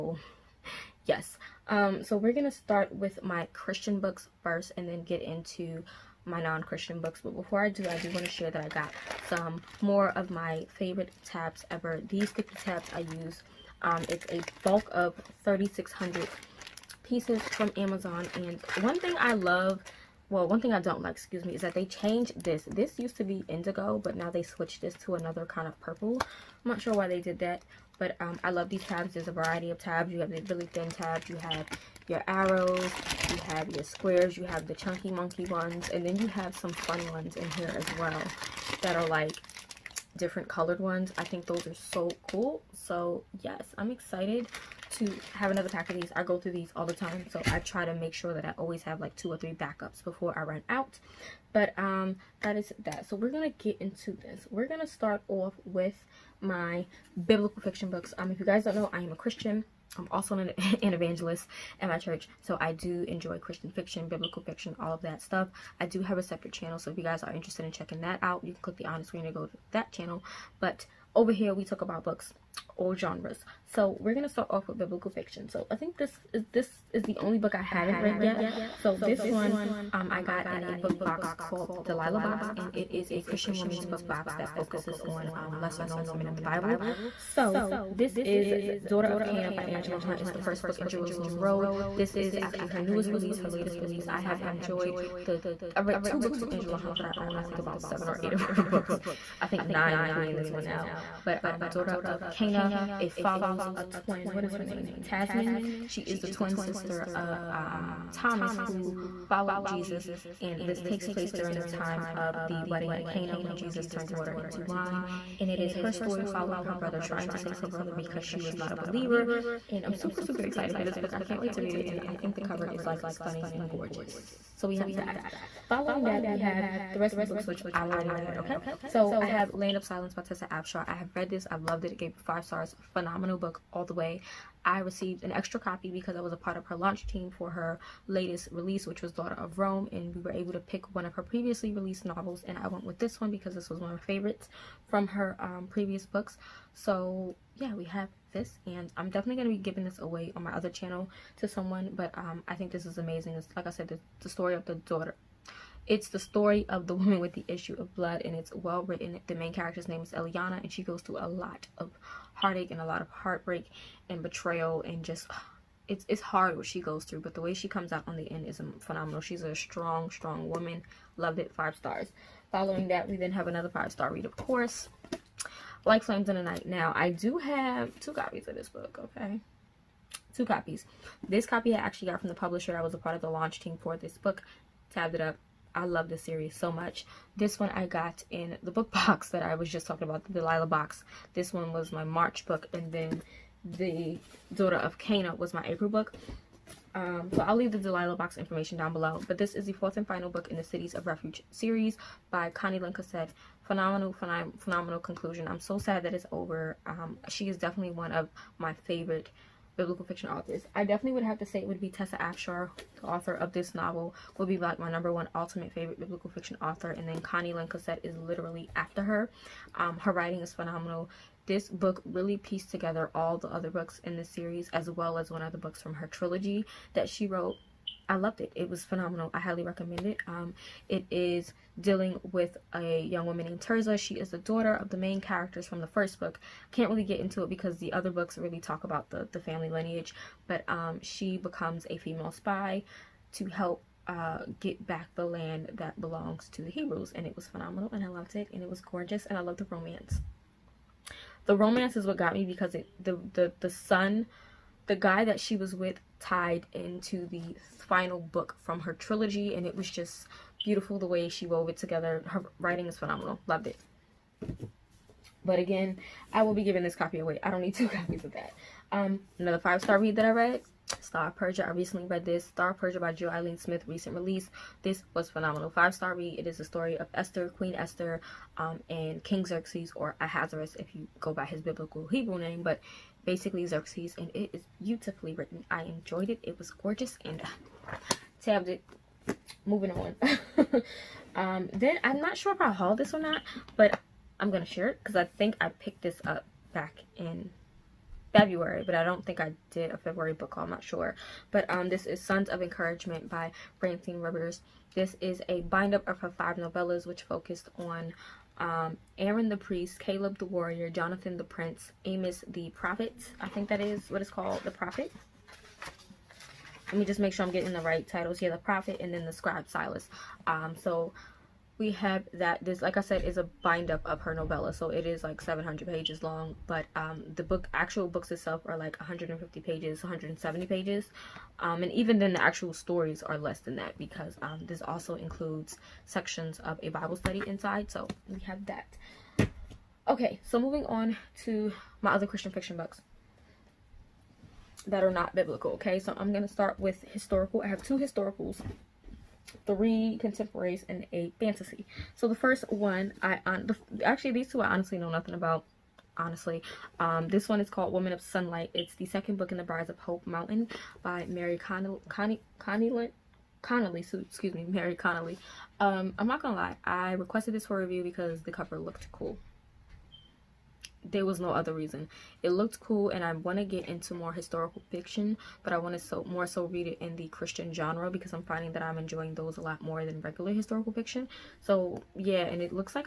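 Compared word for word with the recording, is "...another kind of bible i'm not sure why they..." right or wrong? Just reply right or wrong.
wrong.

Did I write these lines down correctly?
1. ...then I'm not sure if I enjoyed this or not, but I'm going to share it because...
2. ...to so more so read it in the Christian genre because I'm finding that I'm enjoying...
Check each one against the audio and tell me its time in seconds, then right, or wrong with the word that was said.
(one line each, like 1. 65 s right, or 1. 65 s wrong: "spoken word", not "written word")
1. 291 s wrong: "hauled", not "enjoyed"
2. 375 s right.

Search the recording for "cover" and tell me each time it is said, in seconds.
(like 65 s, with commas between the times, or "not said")
122 s, 368 s.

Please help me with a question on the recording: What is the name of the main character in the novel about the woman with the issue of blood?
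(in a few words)
Eliana.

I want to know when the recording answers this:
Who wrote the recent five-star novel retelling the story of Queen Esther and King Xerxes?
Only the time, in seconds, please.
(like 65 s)
273 s.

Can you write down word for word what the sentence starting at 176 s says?
Now, I do have two copies of this book, okay?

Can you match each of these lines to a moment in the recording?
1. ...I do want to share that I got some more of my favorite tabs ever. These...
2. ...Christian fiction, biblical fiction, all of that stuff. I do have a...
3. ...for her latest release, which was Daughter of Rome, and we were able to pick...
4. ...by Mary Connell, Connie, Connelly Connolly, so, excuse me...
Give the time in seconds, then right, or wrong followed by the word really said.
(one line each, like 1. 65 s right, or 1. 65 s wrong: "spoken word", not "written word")
1. 7 s right
2. 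63 s right
3. 137 s right
4. 361 s right.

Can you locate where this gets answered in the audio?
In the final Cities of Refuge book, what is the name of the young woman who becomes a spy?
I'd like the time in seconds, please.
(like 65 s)
233 s.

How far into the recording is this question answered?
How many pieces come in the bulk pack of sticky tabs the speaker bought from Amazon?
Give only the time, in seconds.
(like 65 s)
15 s.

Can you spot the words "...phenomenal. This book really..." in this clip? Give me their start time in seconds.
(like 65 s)
220 s.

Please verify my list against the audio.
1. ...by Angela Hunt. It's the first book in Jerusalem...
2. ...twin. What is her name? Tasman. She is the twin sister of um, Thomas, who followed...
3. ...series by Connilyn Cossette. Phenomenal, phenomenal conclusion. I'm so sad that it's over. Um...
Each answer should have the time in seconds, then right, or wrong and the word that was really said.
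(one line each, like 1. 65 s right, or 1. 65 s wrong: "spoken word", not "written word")
1. 89 s right
2. 103 s right
3. 201 s right.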